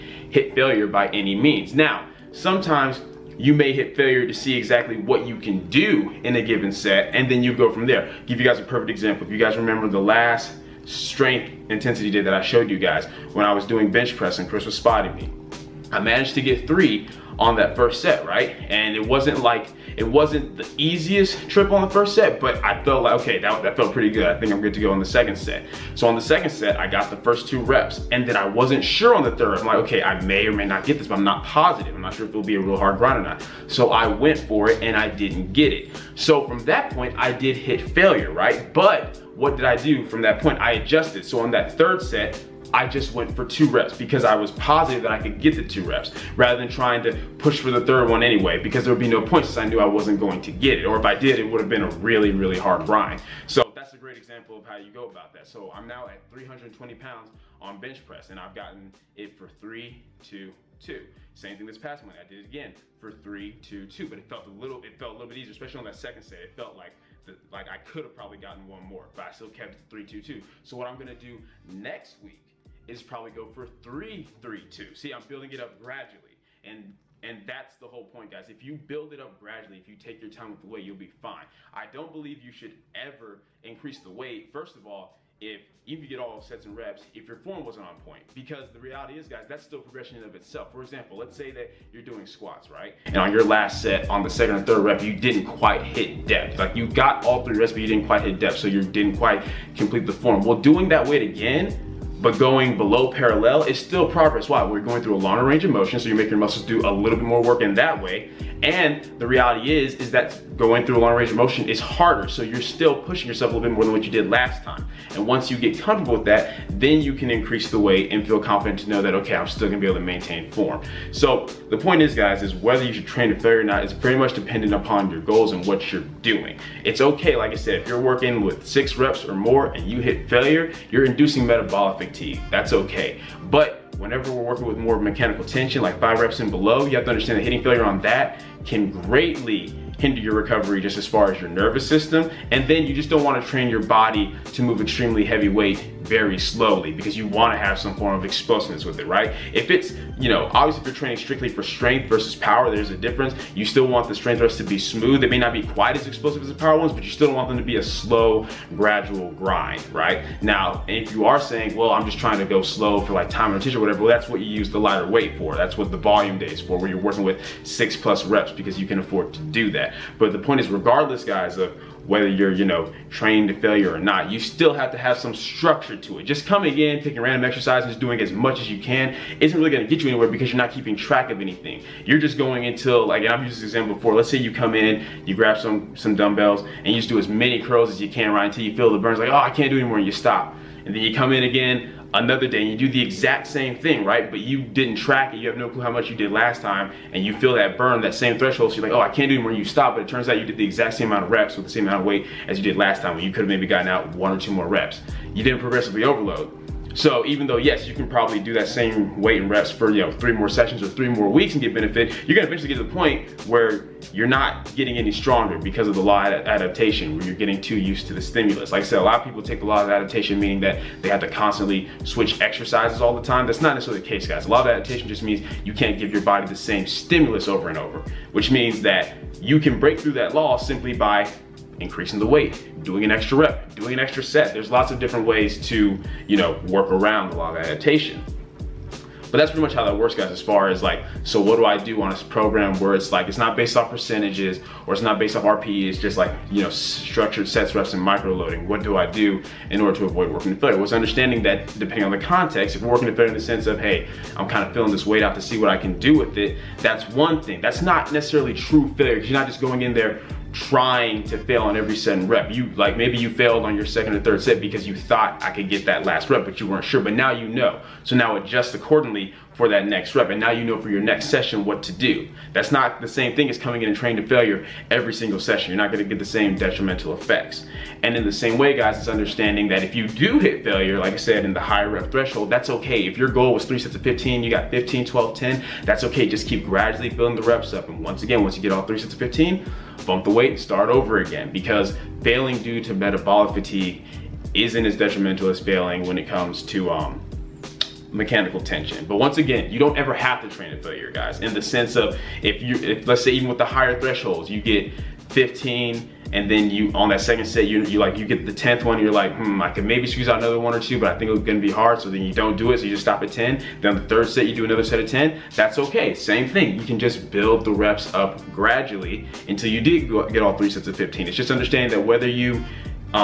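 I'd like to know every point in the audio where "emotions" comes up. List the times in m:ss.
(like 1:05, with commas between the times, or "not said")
not said.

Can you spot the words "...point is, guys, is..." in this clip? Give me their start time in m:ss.
2:01.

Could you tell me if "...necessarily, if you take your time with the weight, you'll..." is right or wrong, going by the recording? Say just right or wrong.
wrong.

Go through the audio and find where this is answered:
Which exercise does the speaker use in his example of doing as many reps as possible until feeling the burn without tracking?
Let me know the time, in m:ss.
3:07.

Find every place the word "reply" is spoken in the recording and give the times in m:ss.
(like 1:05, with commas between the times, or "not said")
not said.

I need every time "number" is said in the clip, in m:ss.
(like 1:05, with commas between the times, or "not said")
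not said.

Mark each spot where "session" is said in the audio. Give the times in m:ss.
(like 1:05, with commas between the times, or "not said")
3:30, 4:31, 4:35.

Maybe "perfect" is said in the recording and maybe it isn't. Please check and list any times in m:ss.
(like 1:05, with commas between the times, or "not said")
0:08.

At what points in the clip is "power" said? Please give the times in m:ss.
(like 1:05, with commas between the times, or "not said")
2:32, 2:36.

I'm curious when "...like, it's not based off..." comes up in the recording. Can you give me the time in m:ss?
4:03.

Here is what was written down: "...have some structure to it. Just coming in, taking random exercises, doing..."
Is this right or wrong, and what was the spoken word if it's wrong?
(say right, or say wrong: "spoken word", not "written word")
right.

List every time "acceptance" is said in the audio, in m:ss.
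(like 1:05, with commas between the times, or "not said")
not said.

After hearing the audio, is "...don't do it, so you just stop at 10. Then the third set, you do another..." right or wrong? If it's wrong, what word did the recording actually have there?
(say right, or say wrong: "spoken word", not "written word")
right.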